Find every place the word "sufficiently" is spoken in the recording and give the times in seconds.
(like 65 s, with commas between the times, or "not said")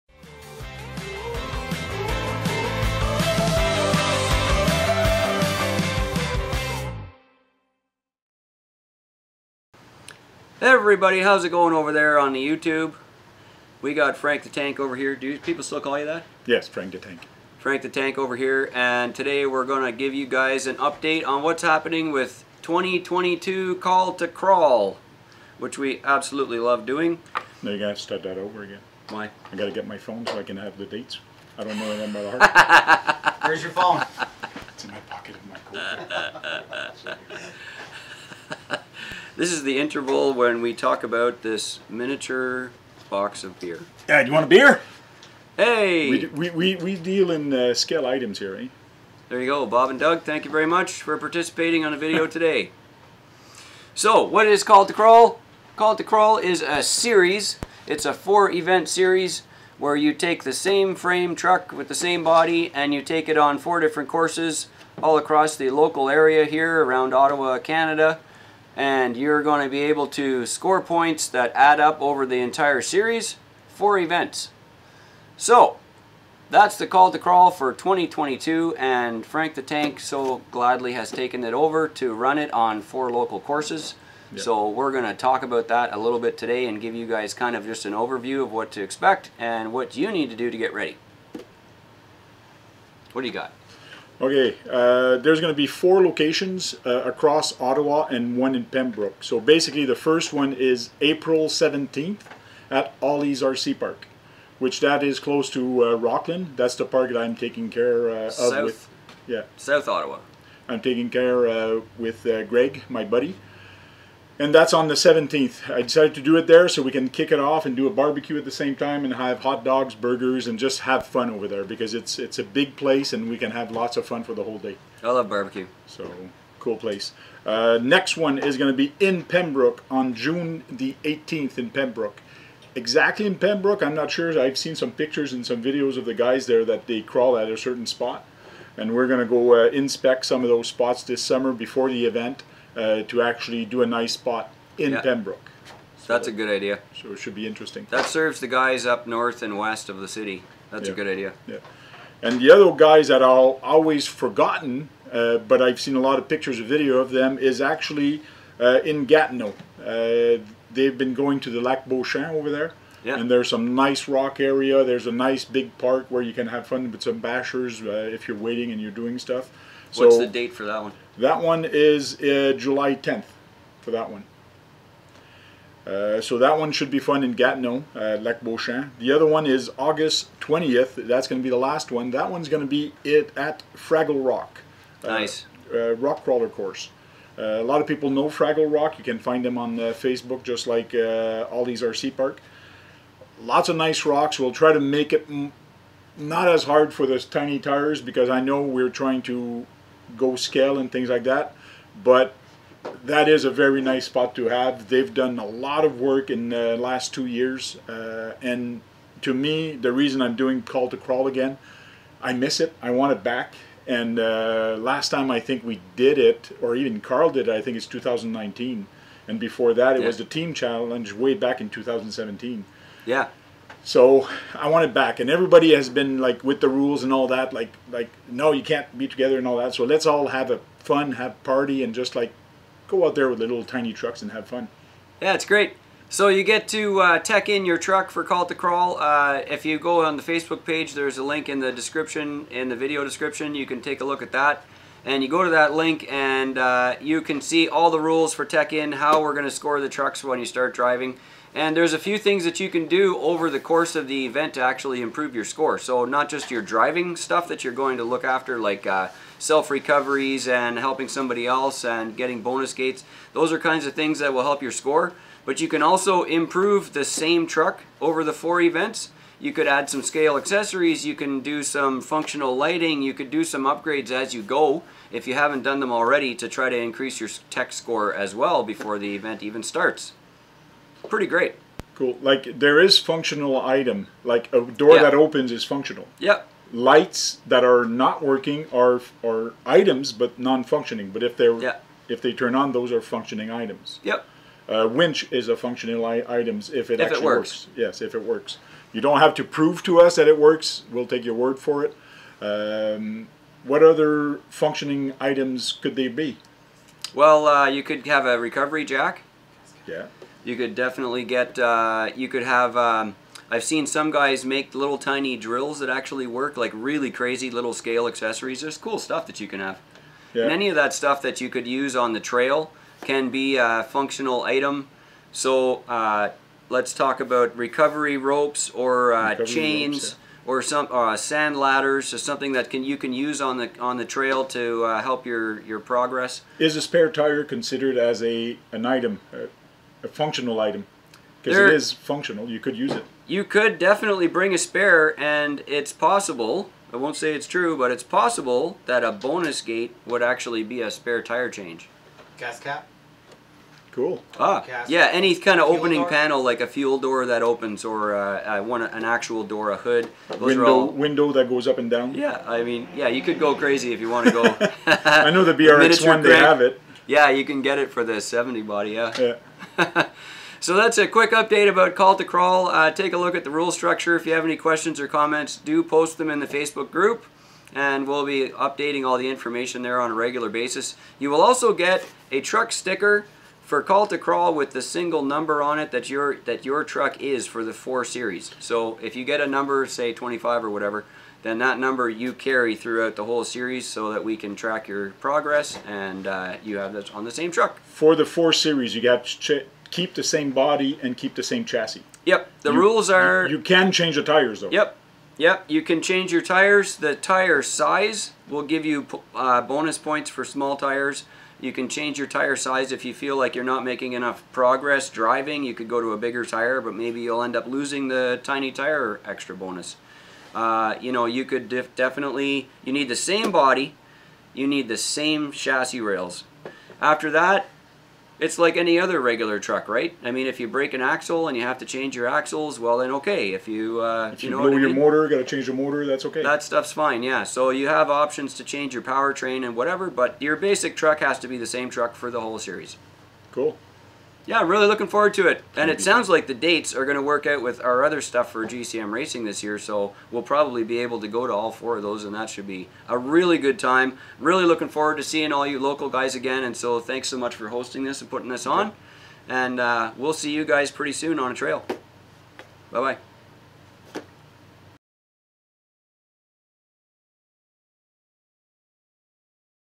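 not said.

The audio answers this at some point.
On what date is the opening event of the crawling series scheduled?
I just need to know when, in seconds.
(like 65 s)
101 s.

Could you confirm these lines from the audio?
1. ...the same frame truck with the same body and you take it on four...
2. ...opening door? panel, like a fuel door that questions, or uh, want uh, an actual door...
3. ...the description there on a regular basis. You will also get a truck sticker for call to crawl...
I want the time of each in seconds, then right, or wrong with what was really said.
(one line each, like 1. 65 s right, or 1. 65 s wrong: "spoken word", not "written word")
1. 60 s right
2. 355 s wrong: "opens", not "questions"
3. 379 s wrong: "information", not "description".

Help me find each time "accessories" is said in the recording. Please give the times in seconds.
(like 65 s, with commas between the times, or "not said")
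270 s, 318 s.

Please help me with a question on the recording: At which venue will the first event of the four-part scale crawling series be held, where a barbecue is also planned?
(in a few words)
Ollie's RC Park.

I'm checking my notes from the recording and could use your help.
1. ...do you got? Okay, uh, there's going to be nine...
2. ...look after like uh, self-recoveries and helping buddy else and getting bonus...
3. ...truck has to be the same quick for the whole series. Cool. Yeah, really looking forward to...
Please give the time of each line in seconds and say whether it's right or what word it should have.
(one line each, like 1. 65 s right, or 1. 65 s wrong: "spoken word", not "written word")
1. 93 s wrong: "four", not "nine"
2. 258 s wrong: "somebody", not "buddy"
3. 440 s wrong: "truck", not "quick".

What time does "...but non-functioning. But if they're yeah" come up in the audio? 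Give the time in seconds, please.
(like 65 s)
290 s.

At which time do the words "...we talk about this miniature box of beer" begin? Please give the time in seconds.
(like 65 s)
40 s.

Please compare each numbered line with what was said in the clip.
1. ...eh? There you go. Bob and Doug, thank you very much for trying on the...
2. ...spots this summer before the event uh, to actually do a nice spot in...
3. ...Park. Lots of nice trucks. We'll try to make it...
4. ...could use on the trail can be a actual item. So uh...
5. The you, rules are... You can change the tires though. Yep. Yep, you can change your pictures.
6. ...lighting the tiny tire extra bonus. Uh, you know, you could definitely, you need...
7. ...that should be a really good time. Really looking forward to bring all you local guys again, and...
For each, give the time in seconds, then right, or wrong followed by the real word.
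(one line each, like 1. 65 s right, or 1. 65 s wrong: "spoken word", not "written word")
1. 48 s wrong: "participating", not "trying"
2. 140 s right
3. 192 s wrong: "rocks", not "trucks"
4. 321 s wrong: "functional", not "actual"
5. 402 s wrong: "tires", not "pictures"
6. 417 s wrong: "losing", not "lighting"
7. 452 s wrong: "seeing", not "bring".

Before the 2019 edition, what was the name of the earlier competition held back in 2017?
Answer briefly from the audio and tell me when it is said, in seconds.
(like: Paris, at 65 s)
team challenge, at 220 s.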